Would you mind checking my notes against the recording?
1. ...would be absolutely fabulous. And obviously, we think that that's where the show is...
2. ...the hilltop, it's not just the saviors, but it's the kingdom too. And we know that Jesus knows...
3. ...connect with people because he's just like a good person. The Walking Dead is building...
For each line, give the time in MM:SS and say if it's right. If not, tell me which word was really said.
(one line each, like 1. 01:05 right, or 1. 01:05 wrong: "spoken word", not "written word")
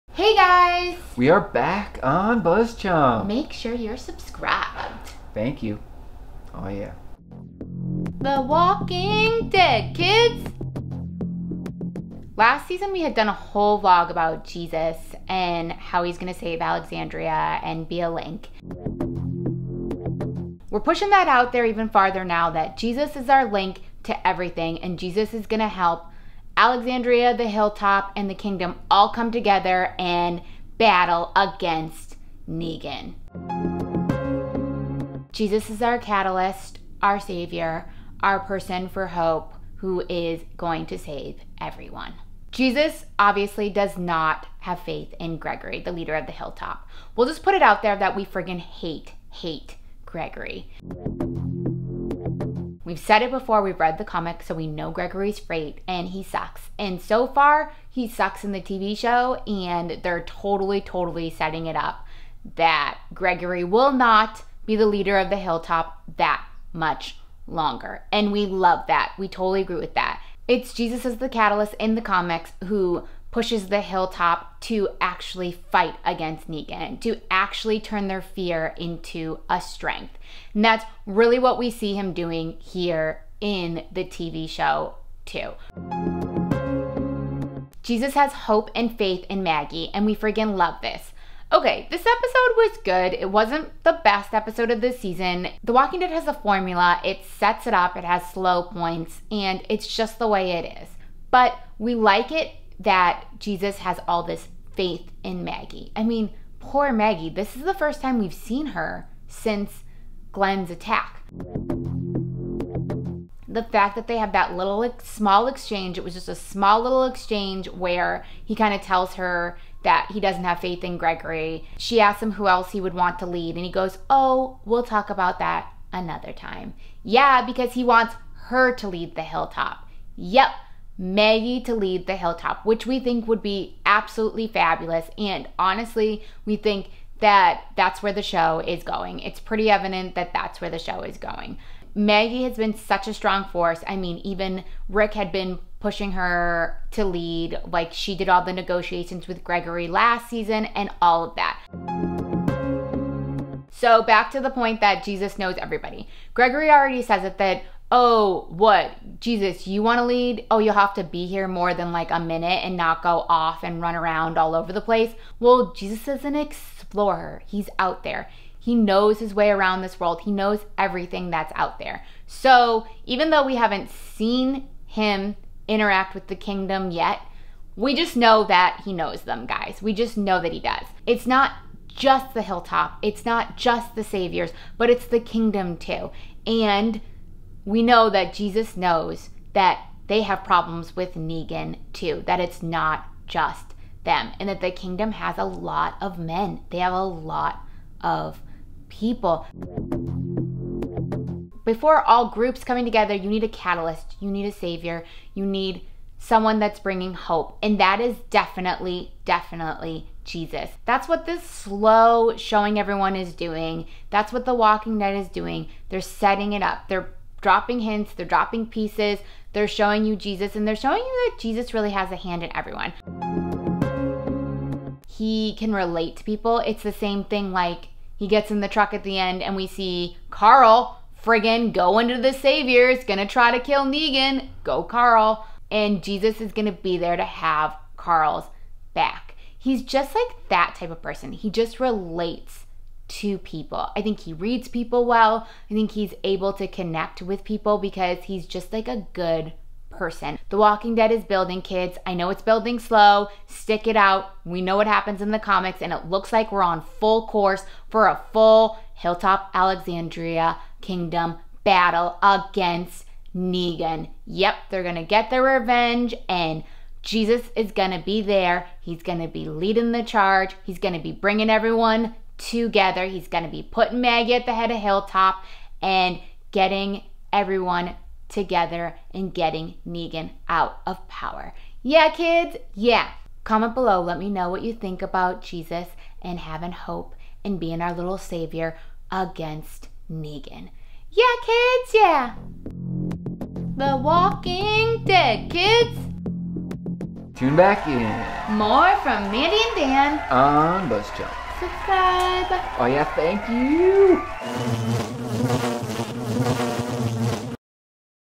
1. 02:13 wrong: "honestly", not "obviously"
2. 03:02 right
3. 04:06 right.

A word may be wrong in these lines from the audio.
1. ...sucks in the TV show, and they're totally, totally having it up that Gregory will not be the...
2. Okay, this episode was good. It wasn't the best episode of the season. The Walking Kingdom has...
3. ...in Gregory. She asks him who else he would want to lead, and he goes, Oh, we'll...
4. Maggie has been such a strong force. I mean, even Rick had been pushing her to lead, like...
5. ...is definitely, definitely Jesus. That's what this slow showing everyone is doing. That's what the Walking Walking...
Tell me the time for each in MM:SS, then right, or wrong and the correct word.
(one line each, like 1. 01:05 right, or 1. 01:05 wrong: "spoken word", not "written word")
1. 00:58 wrong: "setting", not "having"
2. 01:31 wrong: "Dead", not "Kingdom"
3. 02:00 right
4. 02:21 right
5. 03:28 wrong: "Dead", not "Walking".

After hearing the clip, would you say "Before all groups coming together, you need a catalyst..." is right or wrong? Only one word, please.
right.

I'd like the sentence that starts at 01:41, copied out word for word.
But we like it that Jesus has all this faith in Maggie.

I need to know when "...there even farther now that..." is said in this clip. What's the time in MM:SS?
00:21.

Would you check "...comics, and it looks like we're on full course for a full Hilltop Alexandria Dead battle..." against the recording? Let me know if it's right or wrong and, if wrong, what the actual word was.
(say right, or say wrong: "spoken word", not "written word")
wrong: "Kingdom", not "Dead".